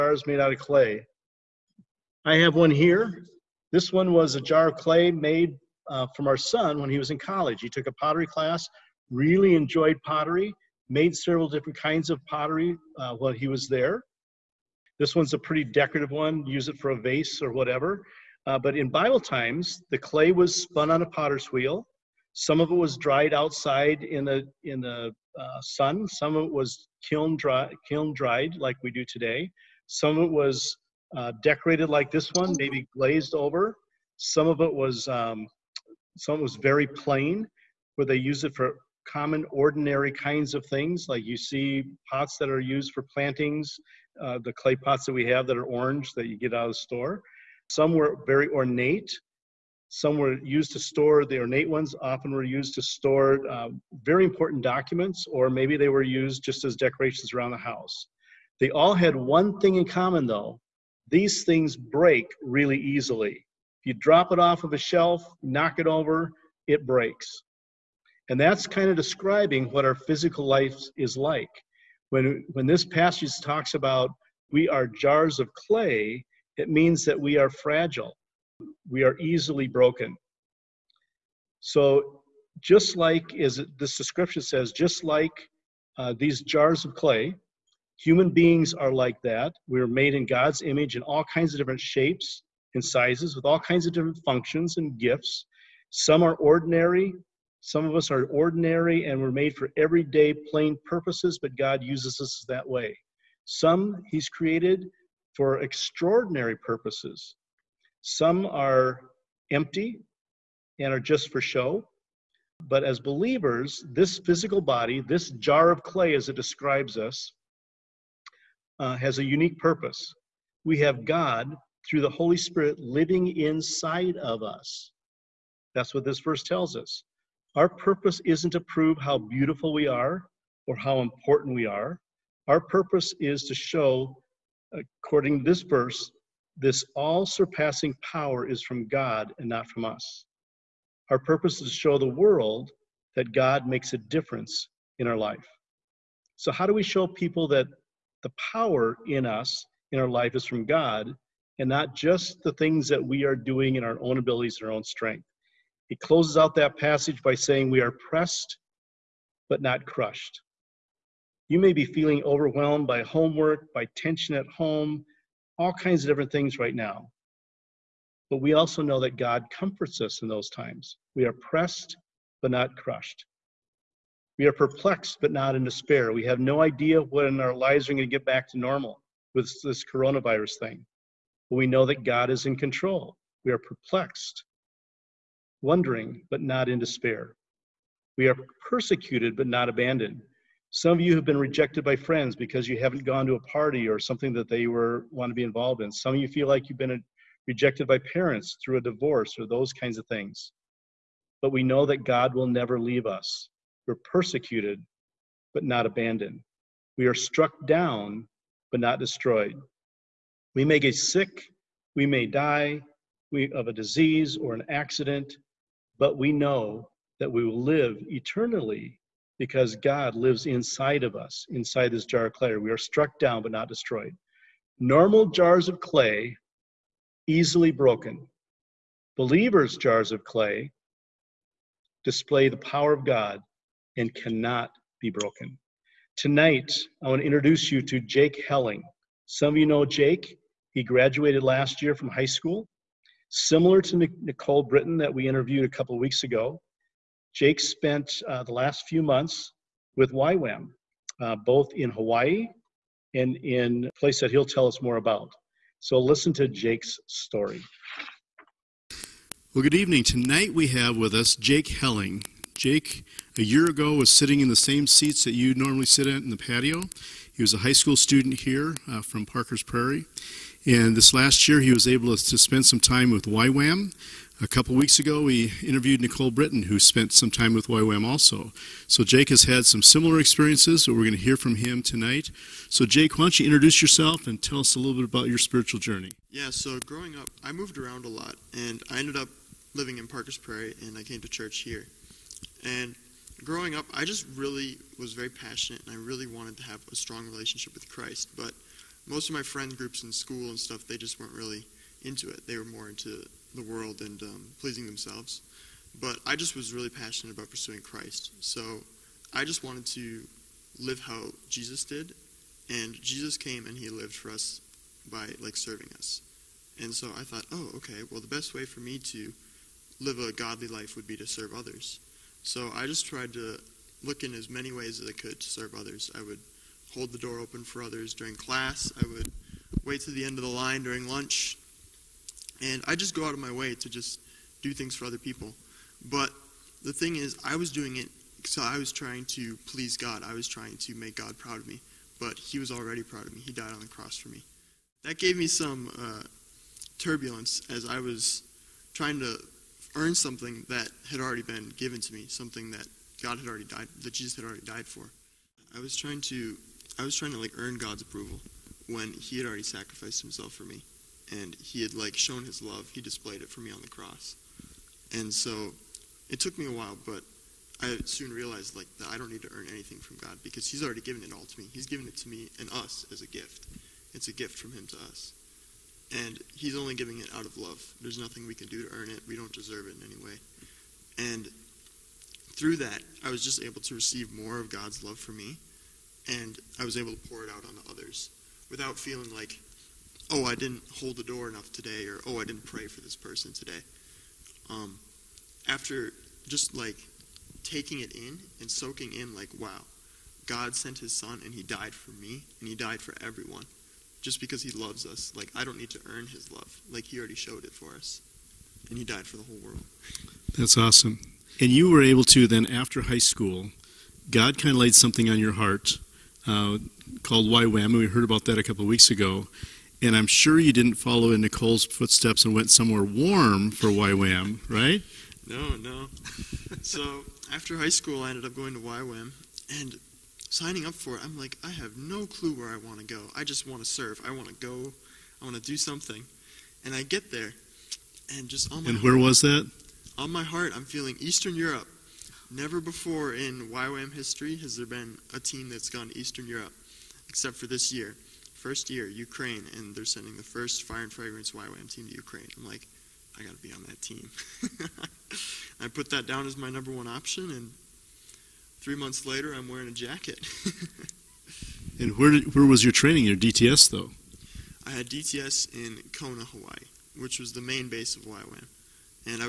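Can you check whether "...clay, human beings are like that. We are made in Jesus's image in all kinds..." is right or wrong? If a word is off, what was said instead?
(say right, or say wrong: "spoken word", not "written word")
wrong: "God", not "Jesus".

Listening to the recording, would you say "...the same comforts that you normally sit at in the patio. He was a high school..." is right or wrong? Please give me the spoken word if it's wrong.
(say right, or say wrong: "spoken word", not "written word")
wrong: "seats", not "comforts".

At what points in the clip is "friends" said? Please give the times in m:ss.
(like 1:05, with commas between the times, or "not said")
3:11, 4:59.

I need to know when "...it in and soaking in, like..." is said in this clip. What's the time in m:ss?
6:38.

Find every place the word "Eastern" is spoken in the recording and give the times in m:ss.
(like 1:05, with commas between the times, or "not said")
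7:21, 7:26.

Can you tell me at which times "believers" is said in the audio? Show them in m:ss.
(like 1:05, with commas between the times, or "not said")
1:53, 3:49.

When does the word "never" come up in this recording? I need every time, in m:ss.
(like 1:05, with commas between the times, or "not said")
3:22, 7:22.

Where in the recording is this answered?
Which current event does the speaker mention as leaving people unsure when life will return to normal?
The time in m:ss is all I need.
2:59.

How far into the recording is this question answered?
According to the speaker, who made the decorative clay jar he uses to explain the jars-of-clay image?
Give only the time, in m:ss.
0:06.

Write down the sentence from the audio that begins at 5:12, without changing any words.
And Jesus came and he lived for us by like serving us.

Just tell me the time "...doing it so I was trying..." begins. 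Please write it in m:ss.
5:37.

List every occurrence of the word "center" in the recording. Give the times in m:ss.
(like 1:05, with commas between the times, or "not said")
not said.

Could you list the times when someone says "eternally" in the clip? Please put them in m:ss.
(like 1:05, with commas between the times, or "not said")
3:38.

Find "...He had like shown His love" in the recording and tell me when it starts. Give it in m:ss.
6:01.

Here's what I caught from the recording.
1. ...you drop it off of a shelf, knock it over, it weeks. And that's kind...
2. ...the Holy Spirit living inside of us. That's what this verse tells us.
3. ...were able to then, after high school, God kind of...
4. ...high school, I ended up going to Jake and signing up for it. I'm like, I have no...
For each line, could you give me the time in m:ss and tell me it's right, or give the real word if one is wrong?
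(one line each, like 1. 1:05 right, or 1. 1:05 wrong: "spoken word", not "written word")
1. 1:03 wrong: "breaks", not "weeks"
2. 2:02 right
3. 6:51 right
4. 7:07 wrong: "YWAM", not "Jake".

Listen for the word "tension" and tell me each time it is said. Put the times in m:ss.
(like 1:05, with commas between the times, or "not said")
2:43.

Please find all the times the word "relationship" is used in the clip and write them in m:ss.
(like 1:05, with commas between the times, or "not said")
4:57.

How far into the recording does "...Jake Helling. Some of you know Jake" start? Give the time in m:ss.
3:58.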